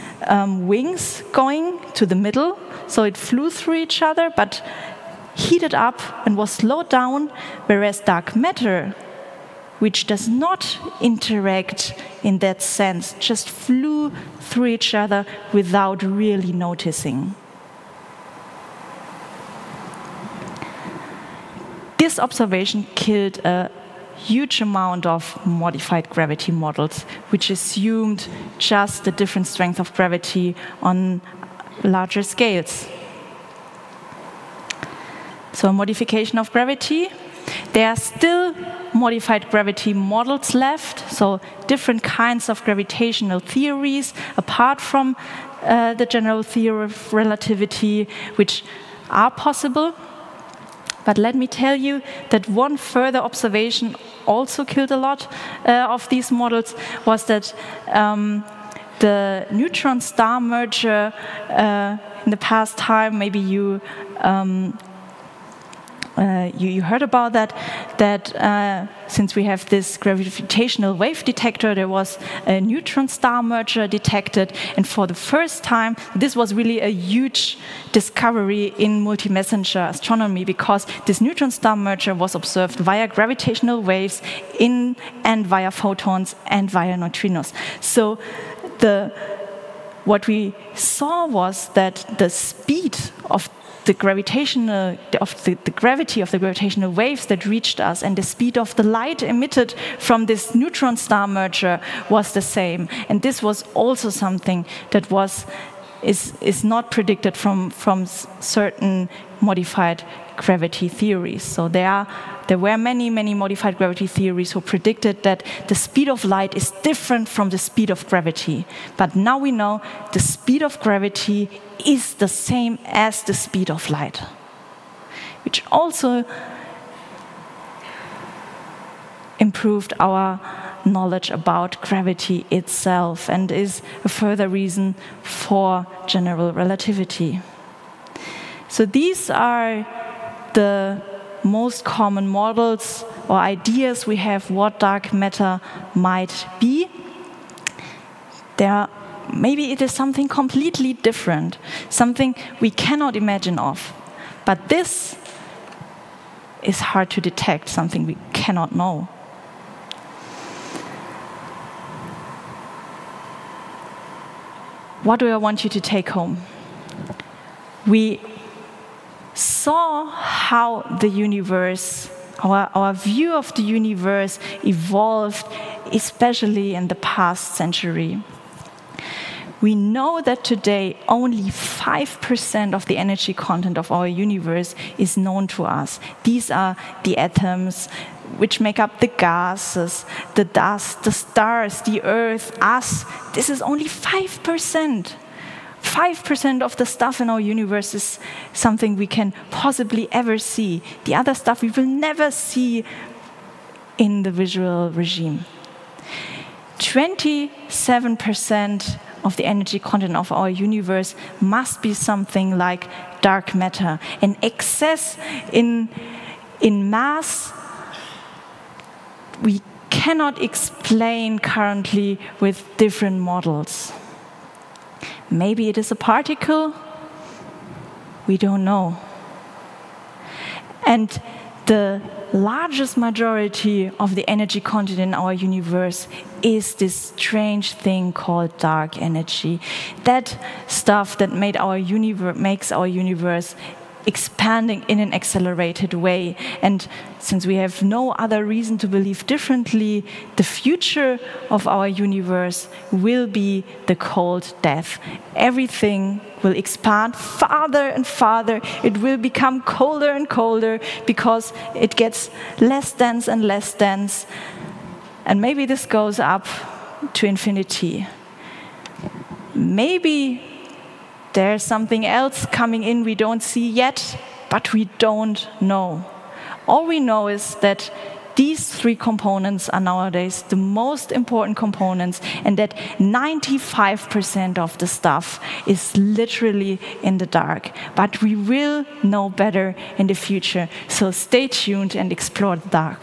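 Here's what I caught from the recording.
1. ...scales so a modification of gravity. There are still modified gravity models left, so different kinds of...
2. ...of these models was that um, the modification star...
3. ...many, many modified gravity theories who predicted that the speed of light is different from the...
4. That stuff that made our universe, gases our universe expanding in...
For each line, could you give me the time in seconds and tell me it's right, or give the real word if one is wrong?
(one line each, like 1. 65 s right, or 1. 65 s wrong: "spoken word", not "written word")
1. 32 s right
2. 55 s wrong: "neutron", not "modification"
3. 112 s right
4. 240 s wrong: "makes", not "gases".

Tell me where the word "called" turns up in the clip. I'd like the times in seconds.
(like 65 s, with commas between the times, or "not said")
238 s.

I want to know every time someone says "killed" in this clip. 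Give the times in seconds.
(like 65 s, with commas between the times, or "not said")
22 s, 54 s.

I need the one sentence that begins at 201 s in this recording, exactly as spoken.
The other stuff we will never see in the visual regime.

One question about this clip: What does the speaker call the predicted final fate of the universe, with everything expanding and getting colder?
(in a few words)
the cold death.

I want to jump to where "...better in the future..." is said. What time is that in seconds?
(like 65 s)
289 s.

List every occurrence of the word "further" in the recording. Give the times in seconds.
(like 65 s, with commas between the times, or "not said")
52 s, 134 s.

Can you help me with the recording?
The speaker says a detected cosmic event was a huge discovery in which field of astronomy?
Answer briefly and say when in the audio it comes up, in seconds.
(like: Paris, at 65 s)
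multi-messenger astronomy, at 79 s.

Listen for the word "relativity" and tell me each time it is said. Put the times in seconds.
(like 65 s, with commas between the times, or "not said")
47 s, 136 s.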